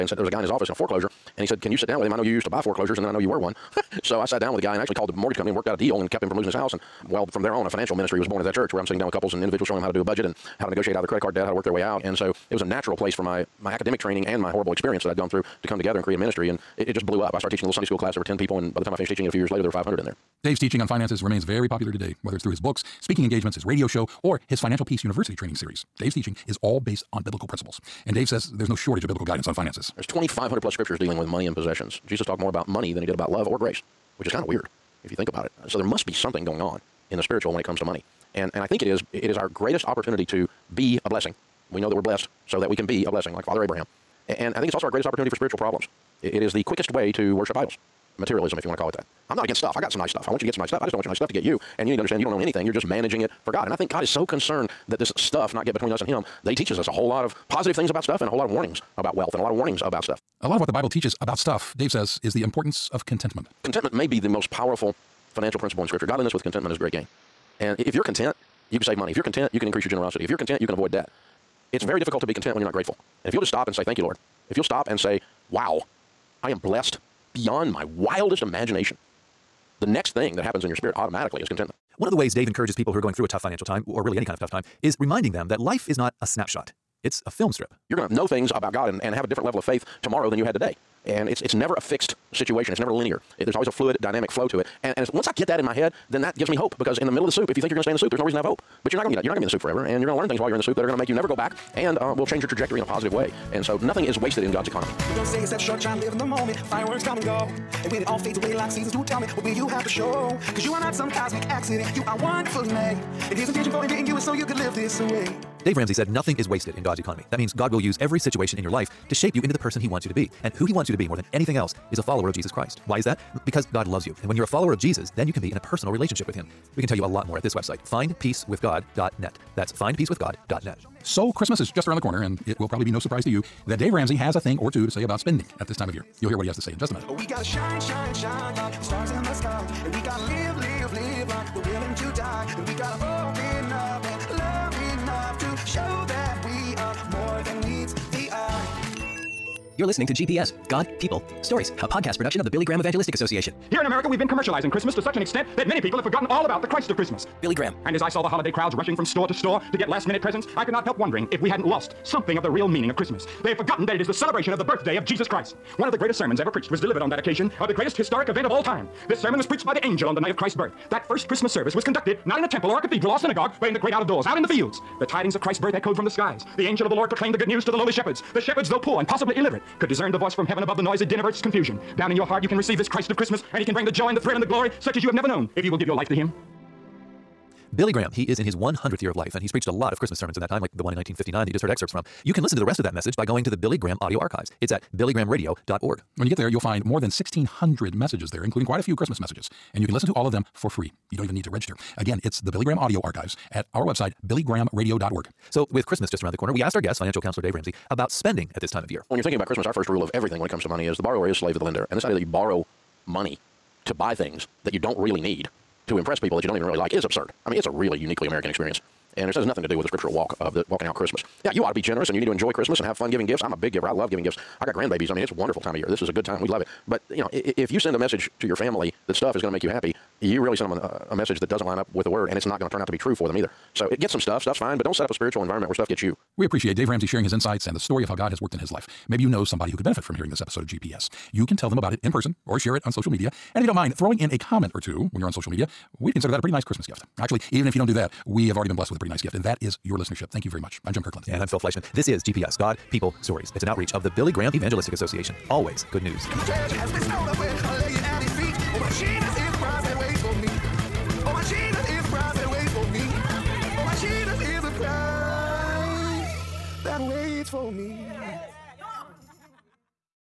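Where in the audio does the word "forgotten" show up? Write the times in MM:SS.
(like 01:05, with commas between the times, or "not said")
02:36, 02:43.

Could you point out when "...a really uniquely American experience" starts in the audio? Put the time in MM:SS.
03:37.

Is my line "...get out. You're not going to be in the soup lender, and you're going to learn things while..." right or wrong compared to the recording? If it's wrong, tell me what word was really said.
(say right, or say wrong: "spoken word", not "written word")
wrong: "forever", not "lender".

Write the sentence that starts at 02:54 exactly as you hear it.
The tidings of Christ's birth echoed from the skies.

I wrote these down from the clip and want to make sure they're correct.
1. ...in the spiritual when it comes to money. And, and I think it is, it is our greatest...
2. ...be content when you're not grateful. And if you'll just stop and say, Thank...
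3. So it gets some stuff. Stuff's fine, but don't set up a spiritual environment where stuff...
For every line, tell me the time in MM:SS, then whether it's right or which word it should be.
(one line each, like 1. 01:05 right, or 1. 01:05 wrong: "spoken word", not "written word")
1. 00:37 right
2. 01:12 right
3. 03:53 right.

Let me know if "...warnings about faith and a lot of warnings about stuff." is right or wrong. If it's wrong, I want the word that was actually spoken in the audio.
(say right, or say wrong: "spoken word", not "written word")
wrong: "wealth", not "faith".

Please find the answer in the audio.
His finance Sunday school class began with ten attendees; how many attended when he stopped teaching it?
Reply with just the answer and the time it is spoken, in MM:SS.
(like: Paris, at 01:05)
500, at 00:19.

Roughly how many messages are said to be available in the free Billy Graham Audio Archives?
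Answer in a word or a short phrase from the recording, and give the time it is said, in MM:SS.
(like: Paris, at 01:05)
1,600, at 03:17.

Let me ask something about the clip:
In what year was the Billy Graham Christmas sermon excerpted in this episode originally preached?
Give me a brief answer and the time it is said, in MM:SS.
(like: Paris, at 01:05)
1959, at 03:10.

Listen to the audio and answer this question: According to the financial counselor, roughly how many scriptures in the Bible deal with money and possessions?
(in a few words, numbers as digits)
2,500.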